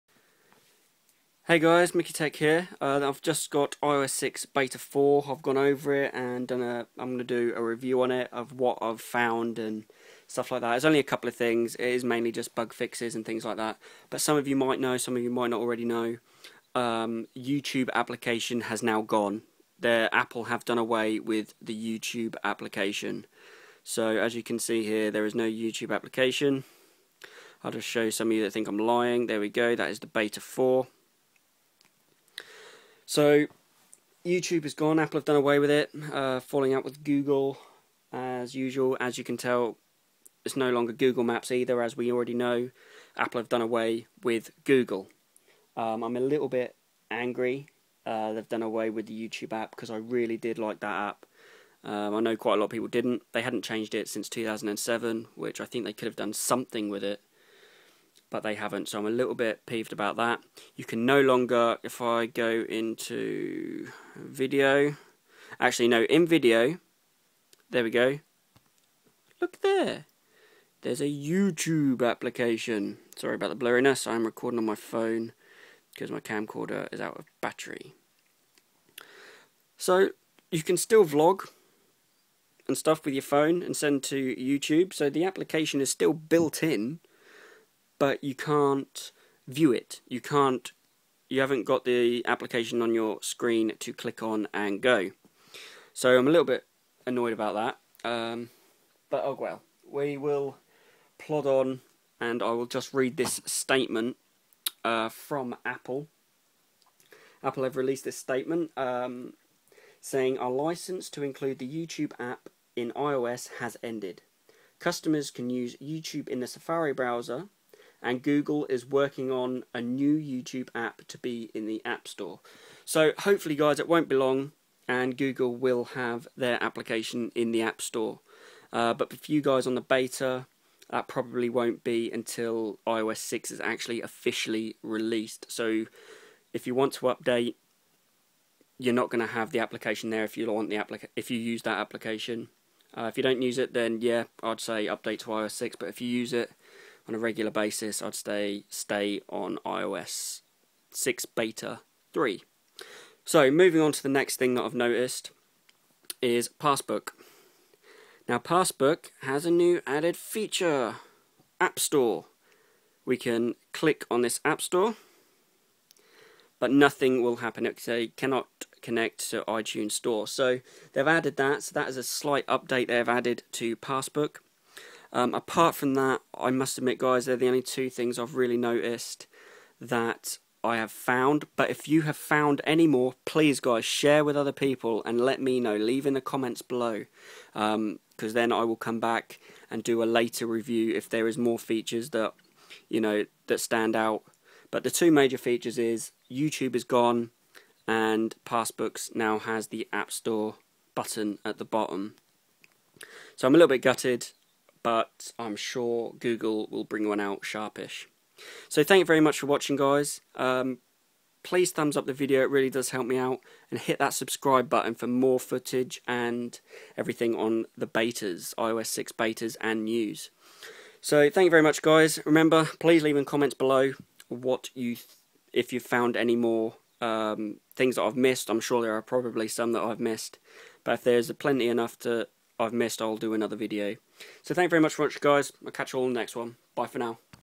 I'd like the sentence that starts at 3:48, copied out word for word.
I'm sure there are probably some that I've missed.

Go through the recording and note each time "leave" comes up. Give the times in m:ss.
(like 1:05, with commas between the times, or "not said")
3:05, 3:43.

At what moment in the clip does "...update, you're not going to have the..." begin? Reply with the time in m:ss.
2:17.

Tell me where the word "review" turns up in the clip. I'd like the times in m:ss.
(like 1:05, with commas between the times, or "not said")
0:07, 3:10.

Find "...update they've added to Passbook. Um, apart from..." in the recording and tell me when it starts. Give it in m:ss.
2:52.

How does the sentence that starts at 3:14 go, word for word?
But the two major features is YouTube is gone and Passbooks now has the App Store button at the bottom.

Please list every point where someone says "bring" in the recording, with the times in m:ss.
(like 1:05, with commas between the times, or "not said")
3:26.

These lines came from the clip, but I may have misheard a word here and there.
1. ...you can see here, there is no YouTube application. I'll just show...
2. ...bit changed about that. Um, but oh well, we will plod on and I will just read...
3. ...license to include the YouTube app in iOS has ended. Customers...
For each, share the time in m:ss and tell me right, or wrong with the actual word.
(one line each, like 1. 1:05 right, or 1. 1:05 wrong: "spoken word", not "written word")
1. 0:24 right
2. 1:36 wrong: "annoyed", not "changed"
3. 1:50 right.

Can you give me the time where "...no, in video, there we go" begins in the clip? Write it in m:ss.
1:05.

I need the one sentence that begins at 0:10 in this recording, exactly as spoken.
It's only a couple of things.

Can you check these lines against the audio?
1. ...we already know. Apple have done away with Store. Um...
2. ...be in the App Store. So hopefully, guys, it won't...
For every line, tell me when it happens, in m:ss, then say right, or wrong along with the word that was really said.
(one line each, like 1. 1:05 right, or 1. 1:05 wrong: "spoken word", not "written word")
1. 0:41 wrong: "Google", not "Store"
2. 2:01 right.